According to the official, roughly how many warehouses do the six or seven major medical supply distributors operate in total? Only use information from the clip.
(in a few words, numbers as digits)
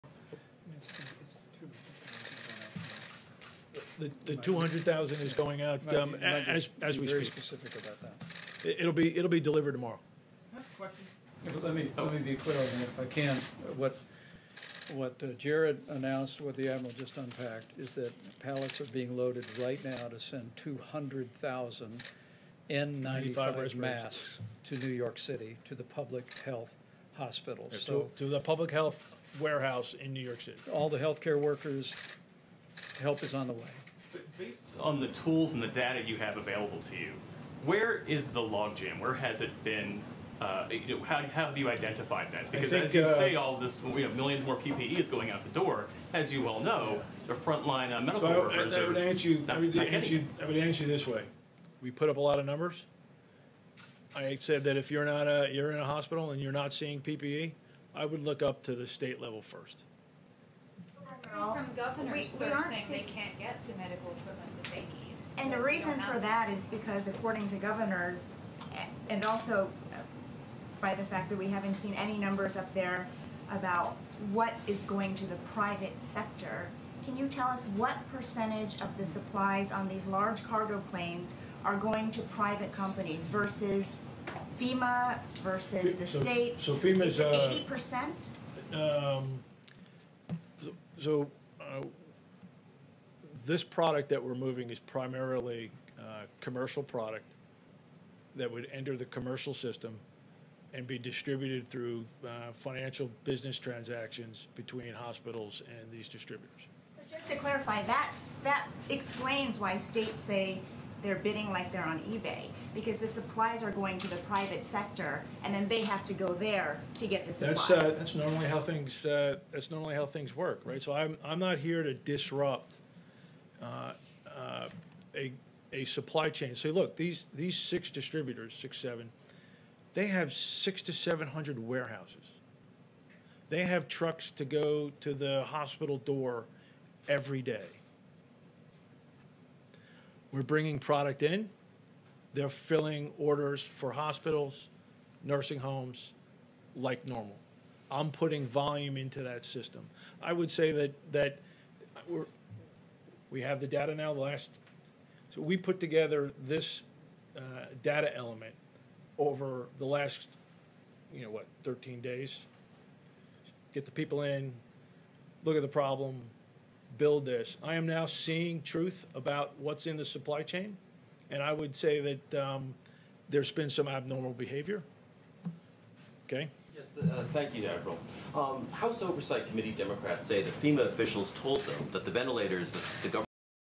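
600 to 700.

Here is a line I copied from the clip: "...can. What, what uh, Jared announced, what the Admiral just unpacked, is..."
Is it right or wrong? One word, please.
right.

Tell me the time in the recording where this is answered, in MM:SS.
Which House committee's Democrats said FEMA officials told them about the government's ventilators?
02:58.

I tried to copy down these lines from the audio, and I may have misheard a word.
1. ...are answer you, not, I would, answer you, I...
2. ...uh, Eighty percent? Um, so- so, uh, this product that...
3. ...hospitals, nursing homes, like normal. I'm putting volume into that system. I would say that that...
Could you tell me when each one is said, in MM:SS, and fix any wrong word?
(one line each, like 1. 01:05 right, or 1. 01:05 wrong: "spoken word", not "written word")
1. 00:48 right
2. 01:27 right
3. 02:23 right.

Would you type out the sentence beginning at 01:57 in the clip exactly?
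That's uh, that's normally how things uh, that's normally how things work, right?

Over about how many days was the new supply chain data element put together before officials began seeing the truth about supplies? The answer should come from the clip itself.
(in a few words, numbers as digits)
13.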